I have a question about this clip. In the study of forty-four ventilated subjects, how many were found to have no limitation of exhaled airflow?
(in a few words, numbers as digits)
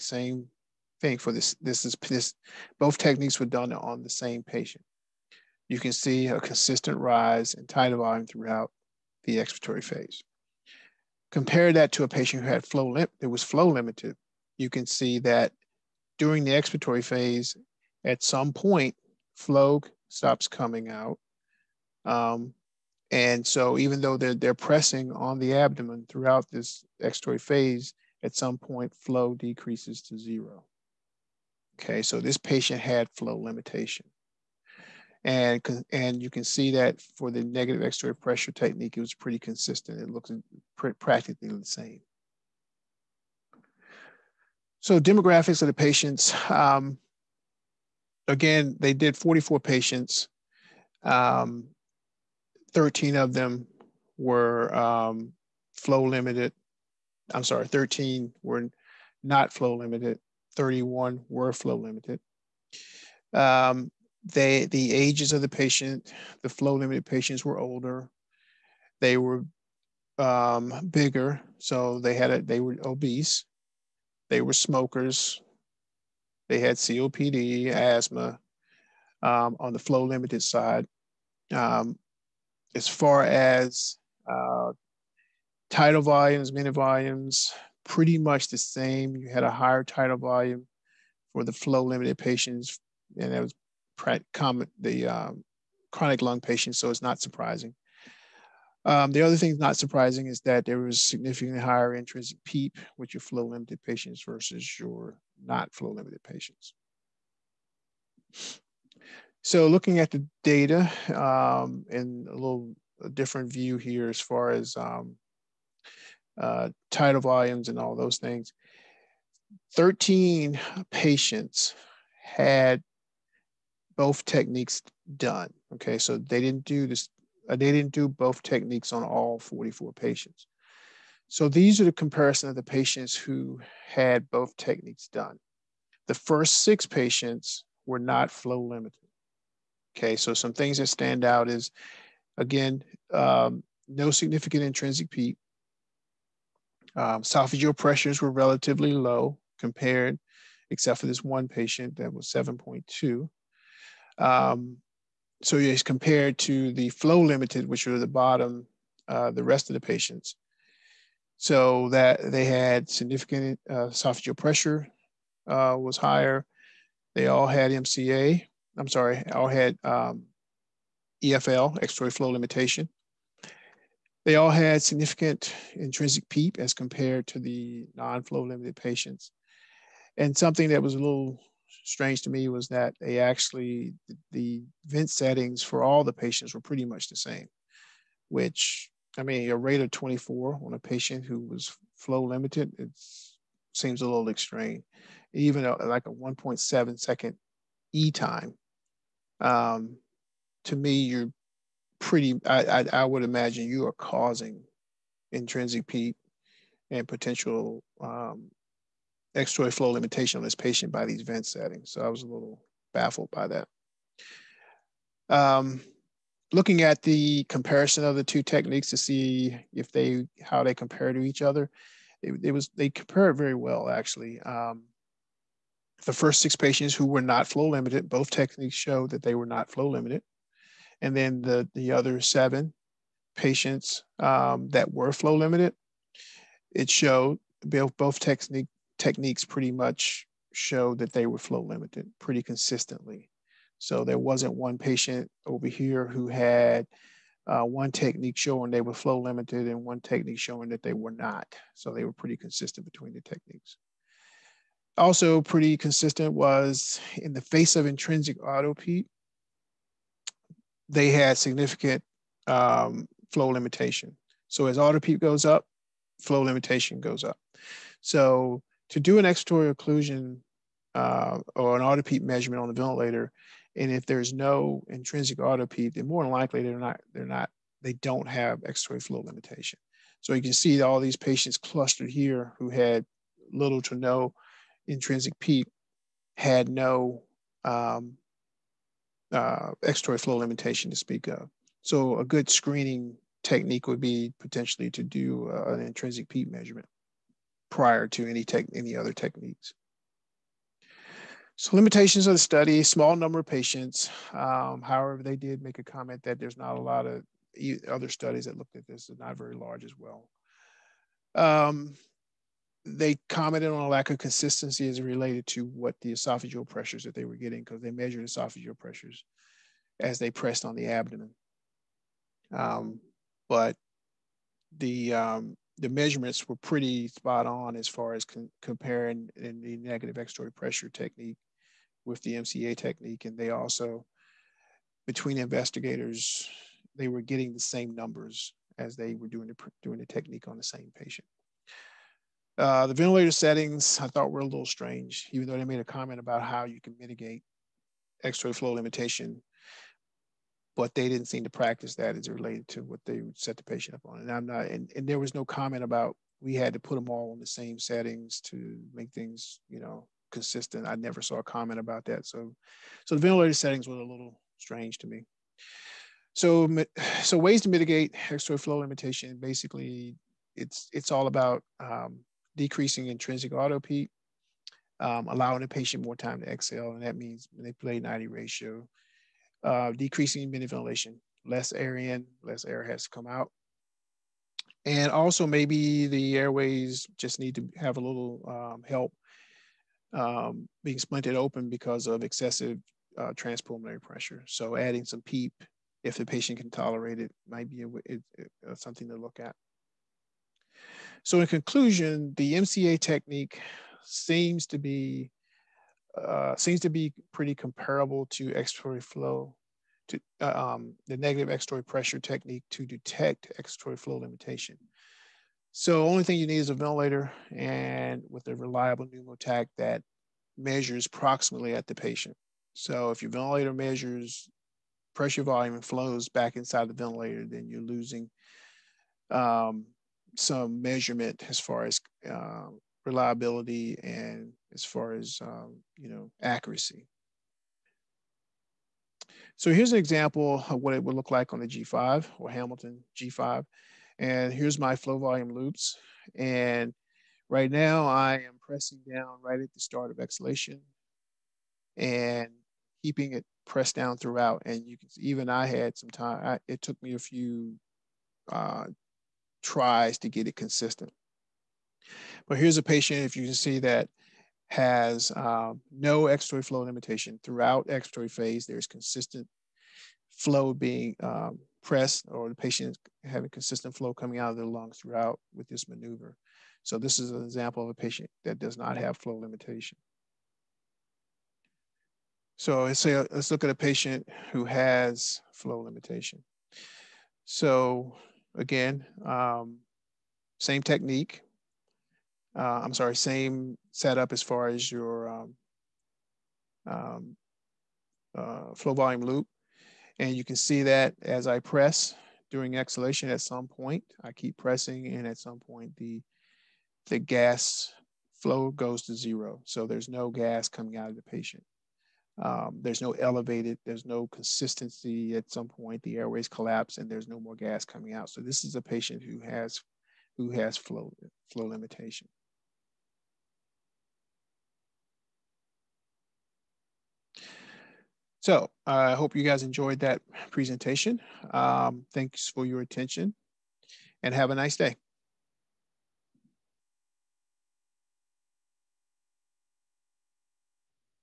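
13.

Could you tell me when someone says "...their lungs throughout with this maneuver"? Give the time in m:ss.
7:54.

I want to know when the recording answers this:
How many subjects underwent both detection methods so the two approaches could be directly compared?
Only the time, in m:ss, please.
1:59.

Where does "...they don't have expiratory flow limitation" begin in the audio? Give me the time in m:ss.
4:37.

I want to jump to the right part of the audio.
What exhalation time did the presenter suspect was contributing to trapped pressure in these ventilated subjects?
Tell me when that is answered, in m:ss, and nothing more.
3:16.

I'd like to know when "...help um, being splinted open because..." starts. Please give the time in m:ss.
6:28.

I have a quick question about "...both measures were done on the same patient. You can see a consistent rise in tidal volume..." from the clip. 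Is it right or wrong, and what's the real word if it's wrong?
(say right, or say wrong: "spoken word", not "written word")
wrong: "techniques", not "measures".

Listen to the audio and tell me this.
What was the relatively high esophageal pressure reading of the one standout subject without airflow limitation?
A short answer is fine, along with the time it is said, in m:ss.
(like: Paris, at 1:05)
7.2, at 2:32.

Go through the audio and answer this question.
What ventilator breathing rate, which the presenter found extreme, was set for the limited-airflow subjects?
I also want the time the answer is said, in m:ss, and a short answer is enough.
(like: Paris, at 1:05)
24, at 3:09.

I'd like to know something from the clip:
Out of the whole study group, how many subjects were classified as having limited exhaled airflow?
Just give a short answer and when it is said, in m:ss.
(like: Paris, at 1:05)
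31, at 1:00.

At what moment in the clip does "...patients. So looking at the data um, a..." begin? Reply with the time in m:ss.
1:46.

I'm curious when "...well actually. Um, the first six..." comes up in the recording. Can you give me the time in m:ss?
3:43.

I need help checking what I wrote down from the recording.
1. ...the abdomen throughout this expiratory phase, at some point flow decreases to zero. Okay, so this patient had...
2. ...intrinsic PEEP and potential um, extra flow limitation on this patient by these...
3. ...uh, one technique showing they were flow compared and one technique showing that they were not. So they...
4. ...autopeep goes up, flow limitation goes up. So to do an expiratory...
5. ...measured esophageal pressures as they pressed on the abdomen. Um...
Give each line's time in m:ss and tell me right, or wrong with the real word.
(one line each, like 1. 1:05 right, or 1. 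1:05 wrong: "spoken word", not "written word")
1. 0:25 right
2. 3:25 right
3. 4:07 wrong: "limited", not "compared"
4. 4:24 right
5. 5:17 right.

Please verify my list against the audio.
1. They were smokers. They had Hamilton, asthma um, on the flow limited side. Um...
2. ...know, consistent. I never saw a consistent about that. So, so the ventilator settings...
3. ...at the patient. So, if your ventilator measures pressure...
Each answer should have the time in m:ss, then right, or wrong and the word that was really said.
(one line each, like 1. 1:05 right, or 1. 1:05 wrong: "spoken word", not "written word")
1. 1:14 wrong: "COPD", not "Hamilton"
2. 5:59 wrong: "comment", not "consistent"
3. 7:01 right.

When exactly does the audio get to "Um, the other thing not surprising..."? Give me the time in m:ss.
1:38.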